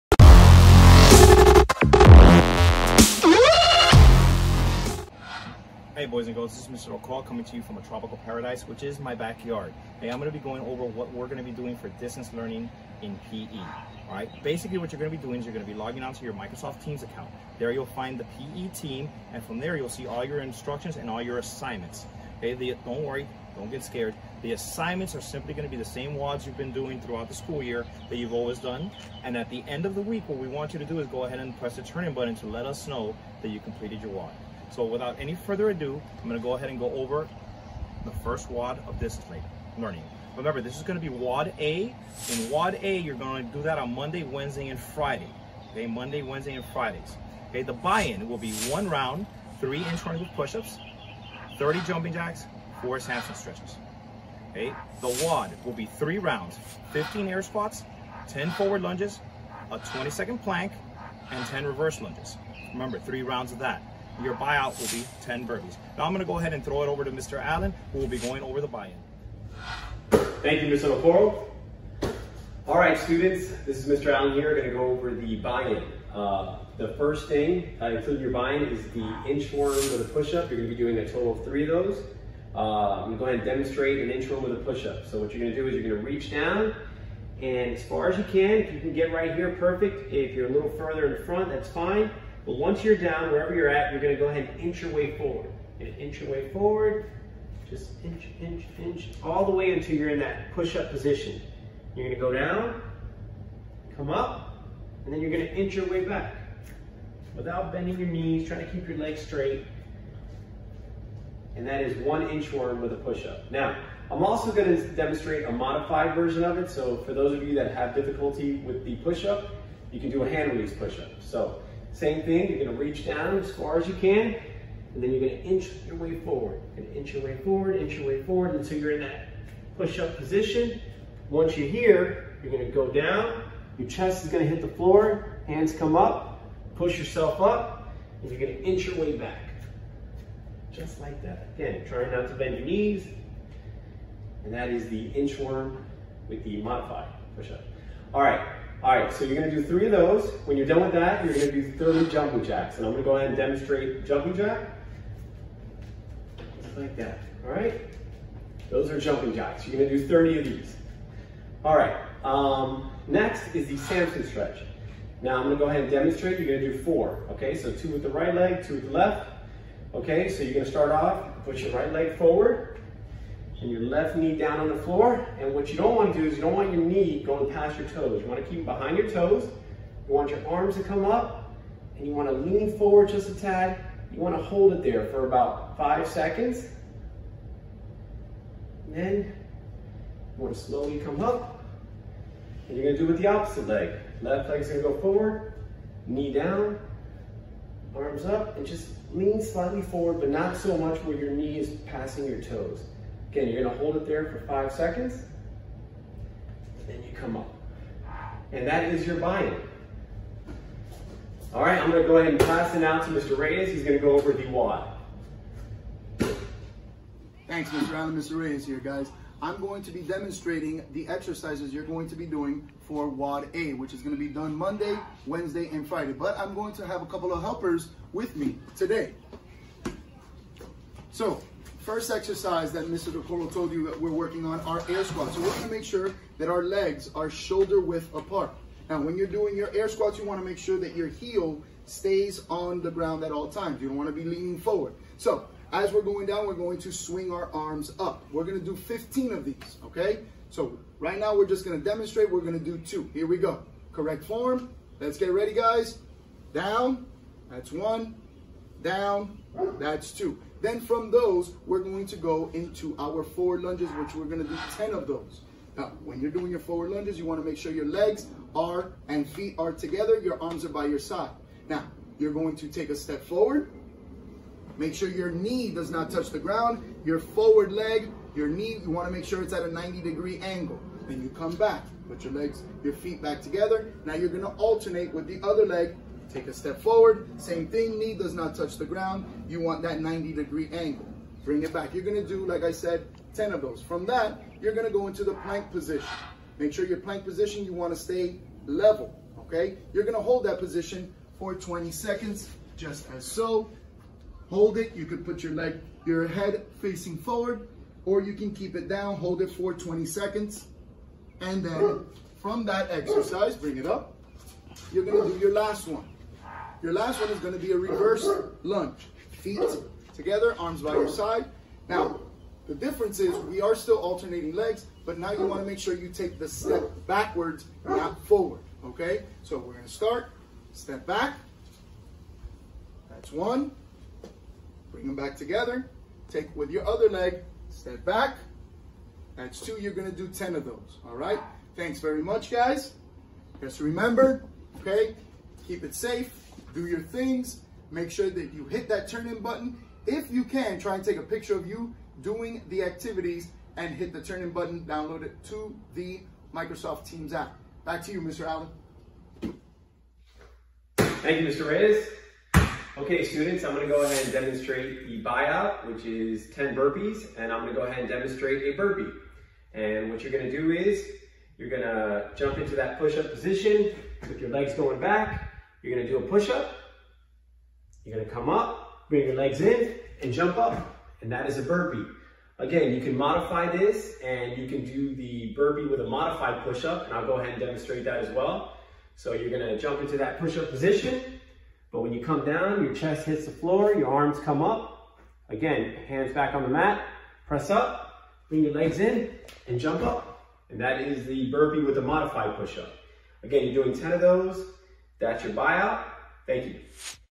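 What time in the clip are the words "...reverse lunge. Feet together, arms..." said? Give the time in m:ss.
5:17.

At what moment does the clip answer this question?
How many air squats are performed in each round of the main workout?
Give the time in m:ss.
4:08.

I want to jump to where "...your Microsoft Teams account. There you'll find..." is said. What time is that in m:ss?
0:16.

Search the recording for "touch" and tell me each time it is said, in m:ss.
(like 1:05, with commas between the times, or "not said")
4:36, 4:48.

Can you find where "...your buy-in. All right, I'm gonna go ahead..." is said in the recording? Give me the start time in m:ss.
3:29.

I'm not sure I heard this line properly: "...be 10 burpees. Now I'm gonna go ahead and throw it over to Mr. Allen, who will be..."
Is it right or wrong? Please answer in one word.
right.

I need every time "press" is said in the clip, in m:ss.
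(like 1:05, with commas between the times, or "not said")
0:31, 6:37.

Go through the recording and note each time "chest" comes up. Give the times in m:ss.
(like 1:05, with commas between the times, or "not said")
2:13, 6:32.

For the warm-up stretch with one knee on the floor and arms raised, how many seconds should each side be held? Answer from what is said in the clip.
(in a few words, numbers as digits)
5.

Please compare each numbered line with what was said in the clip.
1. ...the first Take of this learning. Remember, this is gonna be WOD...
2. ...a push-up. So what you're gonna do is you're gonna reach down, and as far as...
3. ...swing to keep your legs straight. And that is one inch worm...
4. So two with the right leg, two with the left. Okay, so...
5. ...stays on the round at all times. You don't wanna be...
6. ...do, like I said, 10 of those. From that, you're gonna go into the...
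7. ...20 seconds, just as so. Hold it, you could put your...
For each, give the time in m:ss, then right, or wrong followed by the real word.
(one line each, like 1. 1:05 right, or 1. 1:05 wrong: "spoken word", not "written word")
1. 0:38 wrong: "WOD", not "Take"
2. 1:24 right
3. 1:48 wrong: "trying", not "swing"
4. 2:47 right
5. 4:01 wrong: "ground", not "round"
6. 4:52 right
7. 5:01 right.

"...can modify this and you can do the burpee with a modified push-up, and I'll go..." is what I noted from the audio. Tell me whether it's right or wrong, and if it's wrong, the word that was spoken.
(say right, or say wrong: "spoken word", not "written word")
right.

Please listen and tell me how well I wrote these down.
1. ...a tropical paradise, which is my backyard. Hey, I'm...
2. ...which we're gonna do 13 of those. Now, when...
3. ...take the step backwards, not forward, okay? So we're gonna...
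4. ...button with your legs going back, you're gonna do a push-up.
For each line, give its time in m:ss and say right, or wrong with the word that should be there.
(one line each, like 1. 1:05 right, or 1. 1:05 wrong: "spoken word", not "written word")
1. 0:07 right
2. 4:23 wrong: "10", not "13"
3. 5:26 right
4. 6:13 wrong: "position", not "button".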